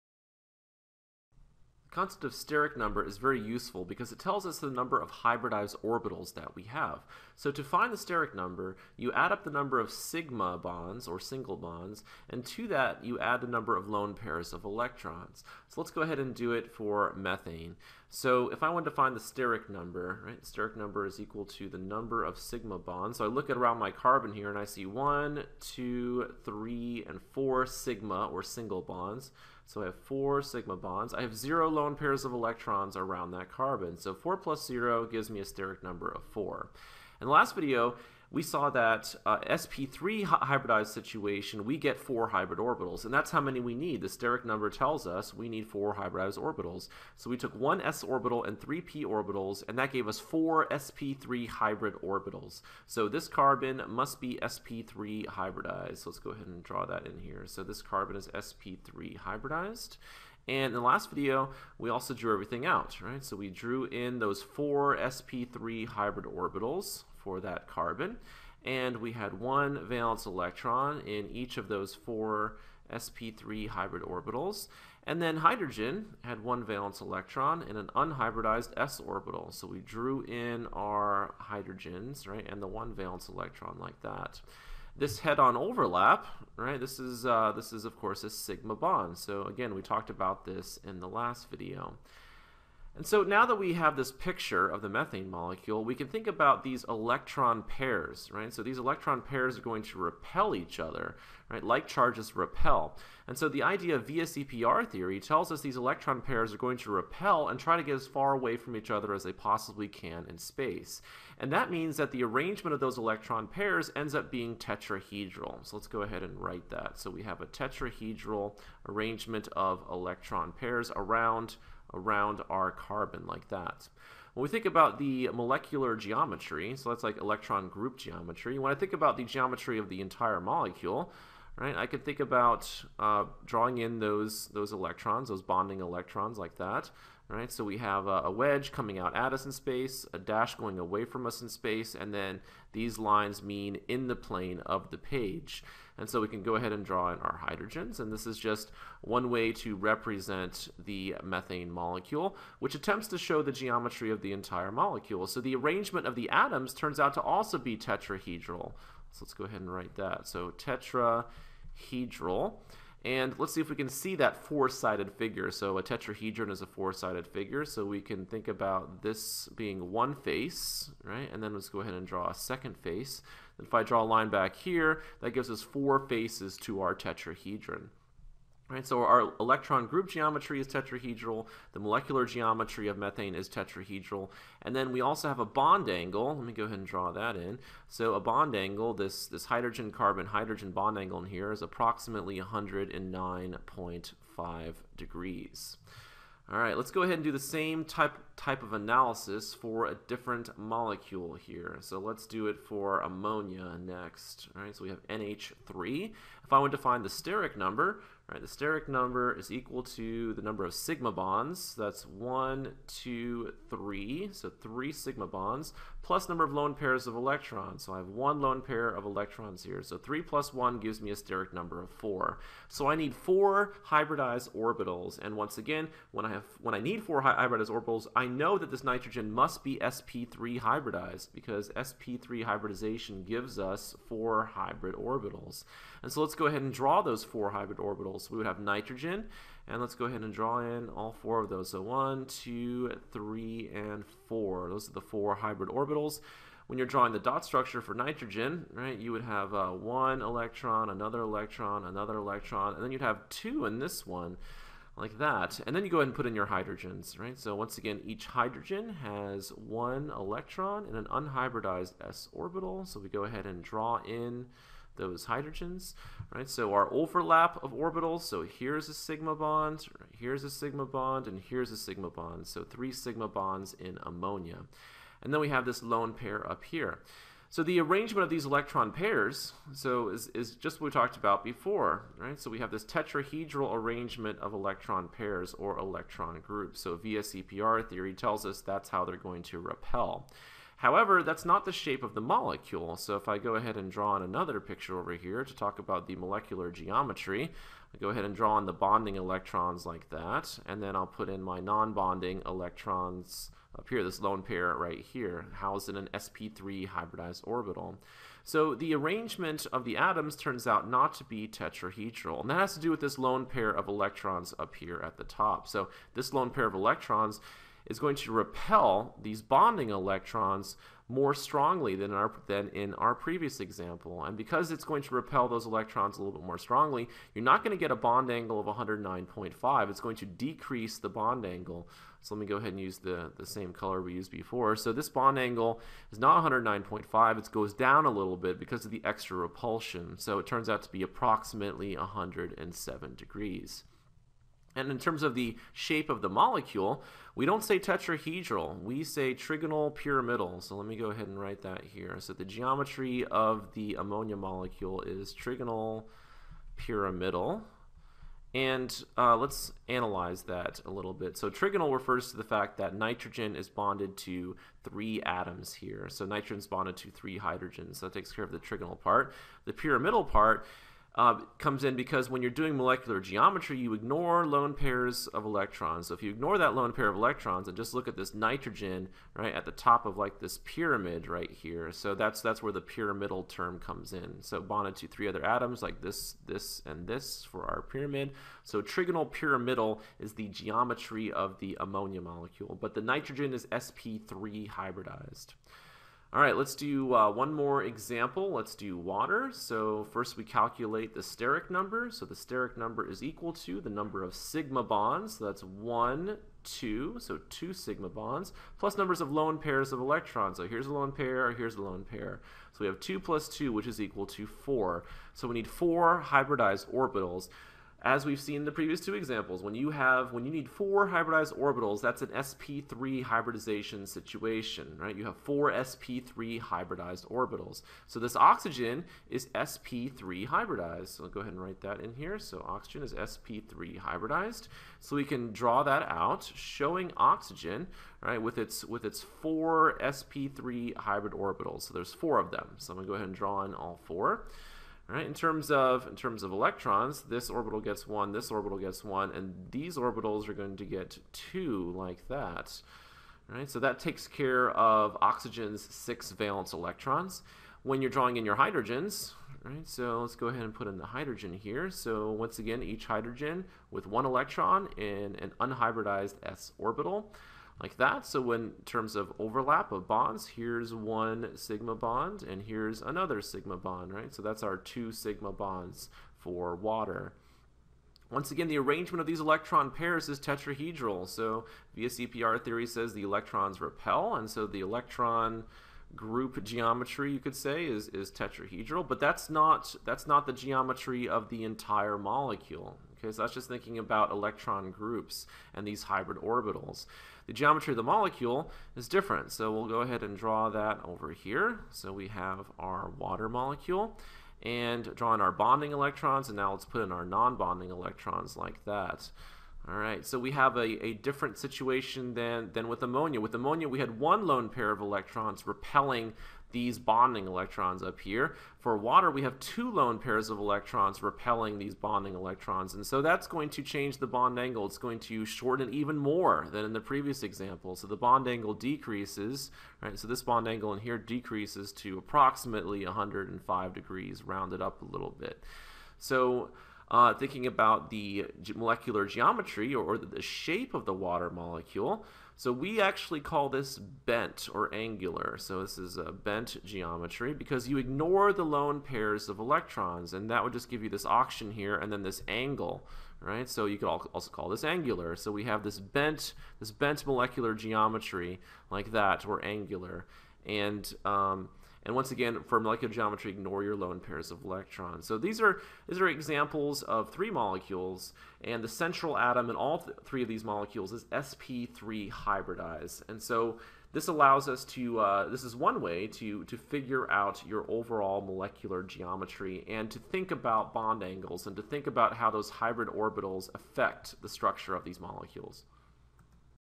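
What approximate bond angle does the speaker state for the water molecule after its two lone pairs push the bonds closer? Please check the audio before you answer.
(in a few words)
105 degrees.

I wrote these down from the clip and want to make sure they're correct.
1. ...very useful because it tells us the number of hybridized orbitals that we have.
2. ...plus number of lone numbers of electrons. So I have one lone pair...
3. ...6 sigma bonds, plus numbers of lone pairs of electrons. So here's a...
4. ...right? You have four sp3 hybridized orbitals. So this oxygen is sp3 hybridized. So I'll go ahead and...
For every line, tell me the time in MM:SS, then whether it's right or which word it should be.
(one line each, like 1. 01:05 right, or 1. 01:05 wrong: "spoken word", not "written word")
1. 00:03 right
2. 03:36 wrong: "pairs", not "numbers"
3. 06:47 wrong: "2", not "6"
4. 07:04 right.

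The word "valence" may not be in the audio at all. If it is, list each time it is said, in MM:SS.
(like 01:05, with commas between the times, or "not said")
01:09, 01:16, 01:22, 07:36.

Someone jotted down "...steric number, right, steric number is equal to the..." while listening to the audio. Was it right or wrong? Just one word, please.
right.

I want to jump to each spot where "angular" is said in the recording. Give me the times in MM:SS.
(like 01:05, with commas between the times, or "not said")
09:04, 09:14, 09:19.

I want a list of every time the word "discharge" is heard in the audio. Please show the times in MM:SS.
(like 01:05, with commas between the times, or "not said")
not said.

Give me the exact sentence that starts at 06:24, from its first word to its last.
So bonded to three other atoms like this, this, and this for our pyramid.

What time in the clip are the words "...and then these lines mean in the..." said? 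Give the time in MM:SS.
02:21.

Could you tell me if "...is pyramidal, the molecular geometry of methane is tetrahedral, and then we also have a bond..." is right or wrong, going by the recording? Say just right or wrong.
wrong.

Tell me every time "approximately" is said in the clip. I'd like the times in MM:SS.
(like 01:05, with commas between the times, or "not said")
03:11, 05:41, 08:52.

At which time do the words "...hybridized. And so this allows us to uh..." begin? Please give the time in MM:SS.
09:32.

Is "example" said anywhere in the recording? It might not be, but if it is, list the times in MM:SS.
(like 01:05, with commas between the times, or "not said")
05:23, 06:37, 06:59, 08:47, 09:26.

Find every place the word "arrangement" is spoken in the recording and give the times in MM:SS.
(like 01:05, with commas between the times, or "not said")
01:52, 01:58, 02:35, 04:37, 04:43, 05:08, 07:58.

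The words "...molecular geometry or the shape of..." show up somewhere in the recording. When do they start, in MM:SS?
08:58.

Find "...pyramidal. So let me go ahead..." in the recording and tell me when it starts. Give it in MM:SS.
05:49.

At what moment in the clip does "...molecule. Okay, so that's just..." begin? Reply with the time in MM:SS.
08:12.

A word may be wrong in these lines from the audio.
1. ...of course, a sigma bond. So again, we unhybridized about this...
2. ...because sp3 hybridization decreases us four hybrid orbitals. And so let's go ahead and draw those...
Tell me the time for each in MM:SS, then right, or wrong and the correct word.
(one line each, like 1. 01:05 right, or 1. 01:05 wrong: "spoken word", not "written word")
1. 01:27 wrong: "talked", not "unhybridized"
2. 03:51 wrong: "gives", not "decreases".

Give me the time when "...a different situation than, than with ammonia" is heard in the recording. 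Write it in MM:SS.
08:31.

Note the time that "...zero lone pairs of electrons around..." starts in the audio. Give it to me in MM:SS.
00:31.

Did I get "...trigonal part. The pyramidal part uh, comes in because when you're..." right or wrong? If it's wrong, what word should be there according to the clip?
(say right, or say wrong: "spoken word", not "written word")
right.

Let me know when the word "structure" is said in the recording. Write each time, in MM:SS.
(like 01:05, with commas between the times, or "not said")
04:07, 09:44.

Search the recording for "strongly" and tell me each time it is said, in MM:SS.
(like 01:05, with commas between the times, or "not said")
05:21, 05:26.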